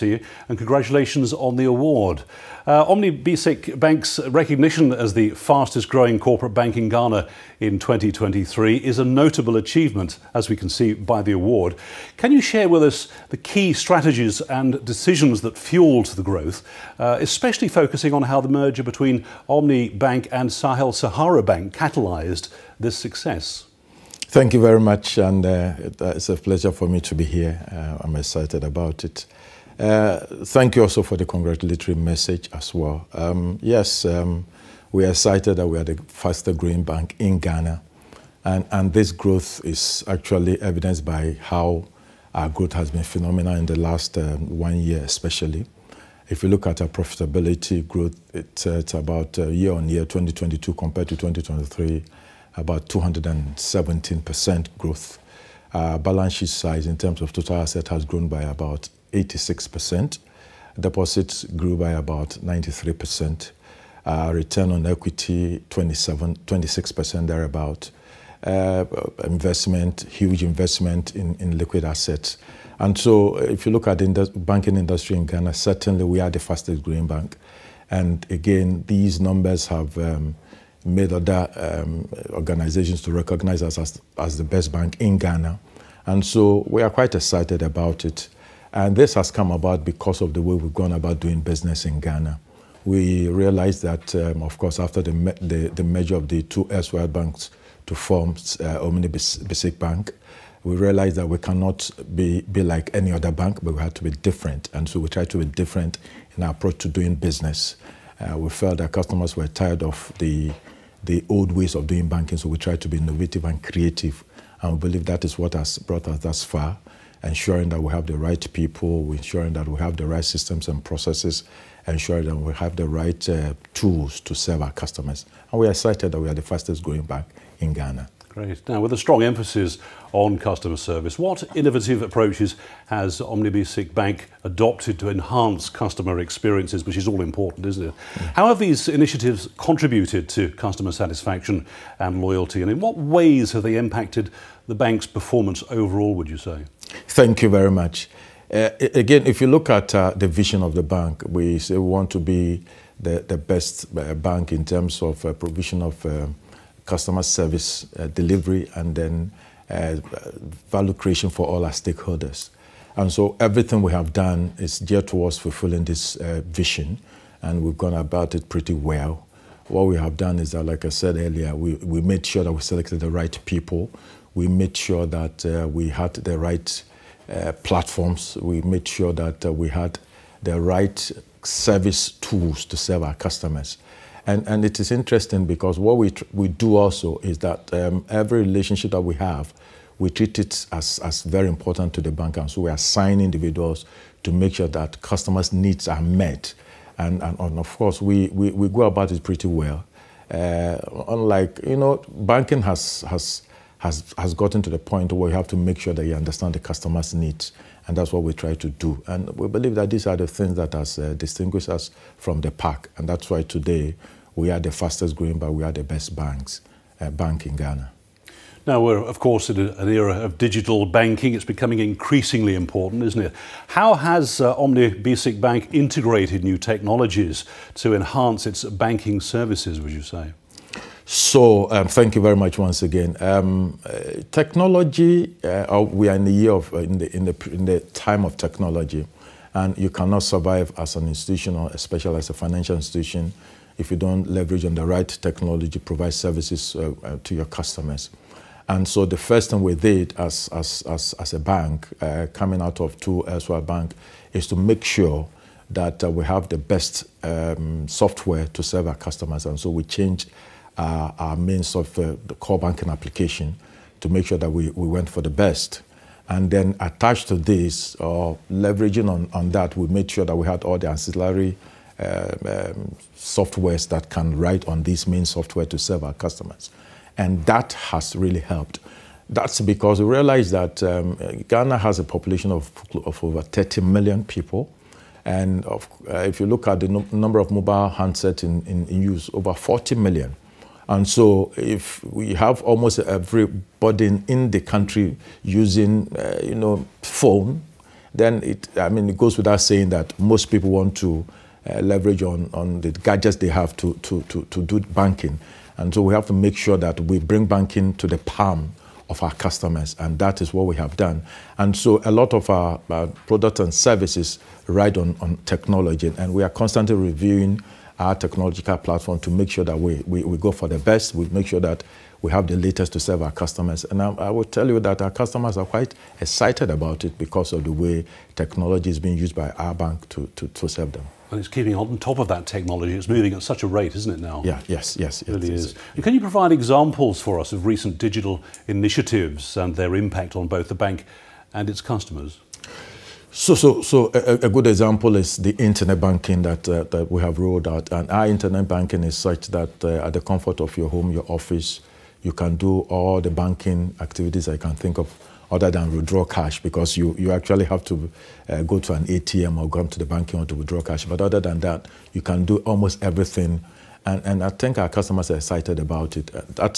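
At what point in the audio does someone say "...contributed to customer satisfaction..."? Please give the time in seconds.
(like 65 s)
139 s.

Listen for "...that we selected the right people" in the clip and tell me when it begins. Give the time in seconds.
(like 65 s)
172 s.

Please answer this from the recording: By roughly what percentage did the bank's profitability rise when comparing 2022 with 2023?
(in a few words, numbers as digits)
217%.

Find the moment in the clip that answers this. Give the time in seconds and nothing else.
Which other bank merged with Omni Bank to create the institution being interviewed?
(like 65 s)
20 s.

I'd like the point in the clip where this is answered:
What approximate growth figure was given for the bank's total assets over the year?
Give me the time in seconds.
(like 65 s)
59 s.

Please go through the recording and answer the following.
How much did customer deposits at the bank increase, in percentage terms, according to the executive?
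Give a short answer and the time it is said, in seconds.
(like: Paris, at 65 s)
93%, at 62 s.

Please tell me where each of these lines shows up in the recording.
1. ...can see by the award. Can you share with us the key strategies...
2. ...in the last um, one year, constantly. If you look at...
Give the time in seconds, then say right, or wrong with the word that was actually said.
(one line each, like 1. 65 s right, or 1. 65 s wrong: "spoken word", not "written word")
1. 10 s right
2. 43 s wrong: "especially", not "constantly".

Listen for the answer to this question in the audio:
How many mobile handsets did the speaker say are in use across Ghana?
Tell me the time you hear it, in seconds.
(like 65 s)
289 s.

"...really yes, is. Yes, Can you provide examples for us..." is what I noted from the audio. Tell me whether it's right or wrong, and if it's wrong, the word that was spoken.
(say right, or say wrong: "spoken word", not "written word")
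right.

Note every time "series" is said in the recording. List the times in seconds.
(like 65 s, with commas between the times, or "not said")
not said.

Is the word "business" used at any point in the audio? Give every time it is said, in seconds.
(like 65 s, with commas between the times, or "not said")
91 s, 107 s.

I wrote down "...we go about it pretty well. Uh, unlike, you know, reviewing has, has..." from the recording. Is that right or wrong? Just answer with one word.
wrong.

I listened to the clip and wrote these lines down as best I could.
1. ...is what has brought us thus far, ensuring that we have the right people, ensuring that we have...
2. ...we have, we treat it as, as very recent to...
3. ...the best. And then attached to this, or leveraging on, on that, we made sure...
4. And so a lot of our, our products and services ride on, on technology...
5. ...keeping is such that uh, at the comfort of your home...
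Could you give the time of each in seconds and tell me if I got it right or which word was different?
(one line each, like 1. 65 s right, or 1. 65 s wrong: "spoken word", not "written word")
1. 115 s right
2. 189 s wrong: "important", not "recent"
3. 265 s right
4. 311 s right
5. 348 s wrong: "banking", not "keeping".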